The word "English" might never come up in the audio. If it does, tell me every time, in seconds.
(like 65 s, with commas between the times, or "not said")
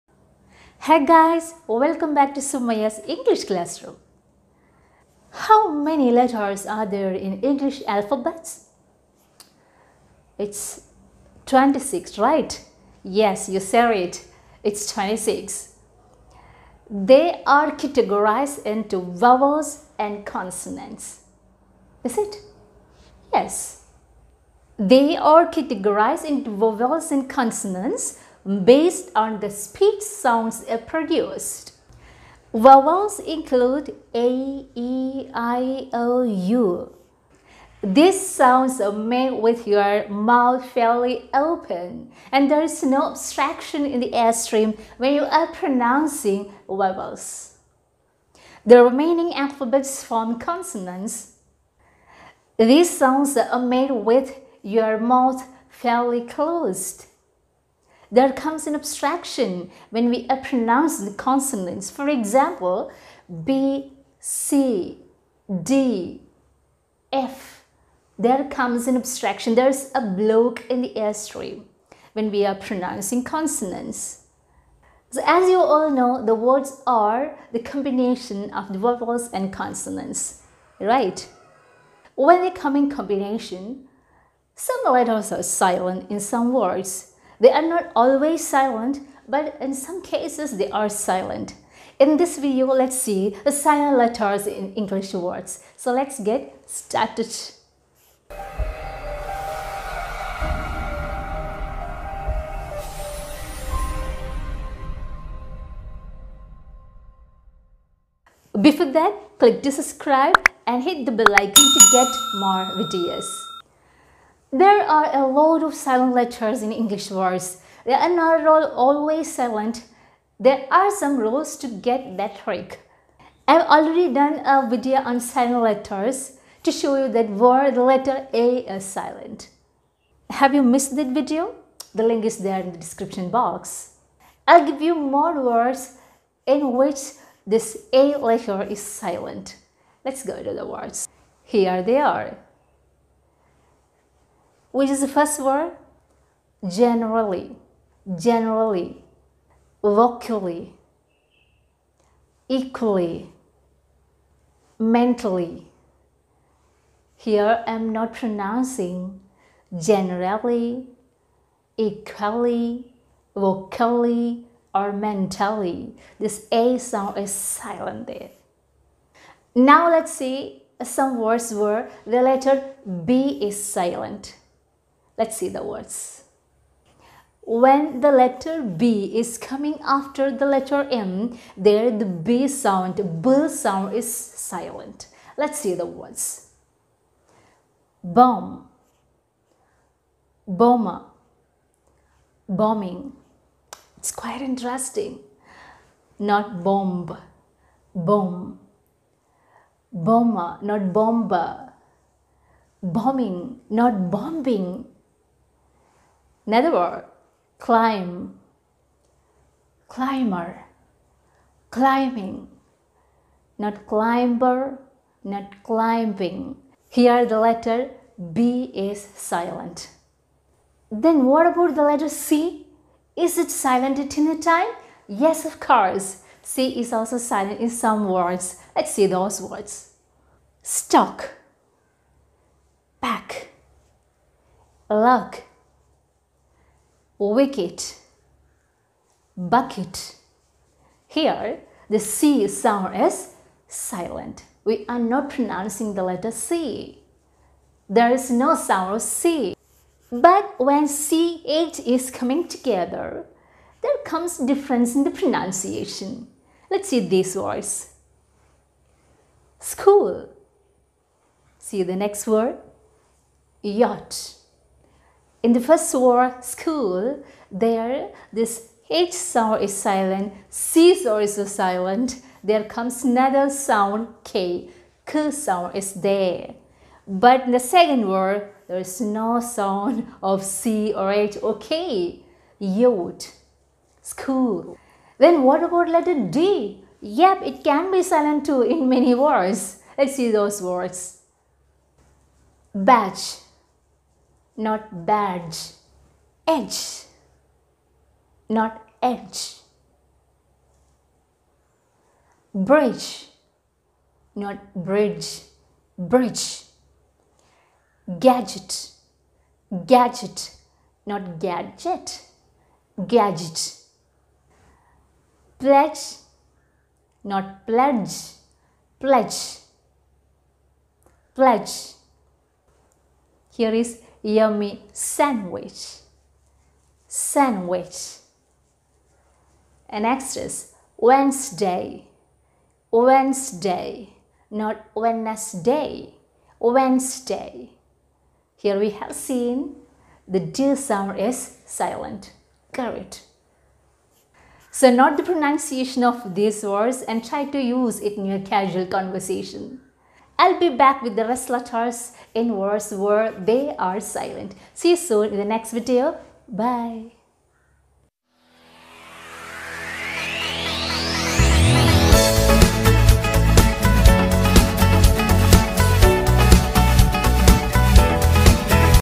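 3 s, 7 s, 94 s, 116 s.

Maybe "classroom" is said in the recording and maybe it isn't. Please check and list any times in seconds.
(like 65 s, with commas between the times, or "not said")
3 s.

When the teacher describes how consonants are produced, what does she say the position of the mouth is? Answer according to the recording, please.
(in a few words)
fairly closed.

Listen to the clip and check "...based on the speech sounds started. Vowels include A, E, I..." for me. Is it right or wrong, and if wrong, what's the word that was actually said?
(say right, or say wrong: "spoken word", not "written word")
wrong: "produced", not "started".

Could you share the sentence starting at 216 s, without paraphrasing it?
Here the letter B is silent.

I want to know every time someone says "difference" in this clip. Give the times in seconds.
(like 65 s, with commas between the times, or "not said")
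254 s.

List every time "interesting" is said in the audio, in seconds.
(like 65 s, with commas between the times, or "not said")
194 s.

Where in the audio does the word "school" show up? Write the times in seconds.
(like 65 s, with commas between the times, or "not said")
259 s, 266 s, 284 s.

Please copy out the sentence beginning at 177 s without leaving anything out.
When the letter B is coming after the letter M, there the B sound, B sound is silent.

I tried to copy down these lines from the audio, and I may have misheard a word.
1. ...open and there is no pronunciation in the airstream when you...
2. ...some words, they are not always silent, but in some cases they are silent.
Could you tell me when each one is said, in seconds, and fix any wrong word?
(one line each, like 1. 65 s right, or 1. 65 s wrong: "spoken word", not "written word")
1. 41 s wrong: "obstruction", not "pronunciation"
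2. 86 s right.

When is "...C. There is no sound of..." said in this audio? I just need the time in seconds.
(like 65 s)
246 s.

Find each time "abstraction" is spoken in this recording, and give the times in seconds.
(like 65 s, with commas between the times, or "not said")
58 s, 68 s.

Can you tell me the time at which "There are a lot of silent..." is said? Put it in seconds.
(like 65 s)
114 s.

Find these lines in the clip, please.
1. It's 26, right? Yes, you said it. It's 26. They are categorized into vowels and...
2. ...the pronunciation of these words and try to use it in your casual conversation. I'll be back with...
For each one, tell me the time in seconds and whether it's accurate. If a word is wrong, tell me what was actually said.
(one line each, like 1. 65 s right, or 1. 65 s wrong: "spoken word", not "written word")
1. 10 s right
2. 345 s right.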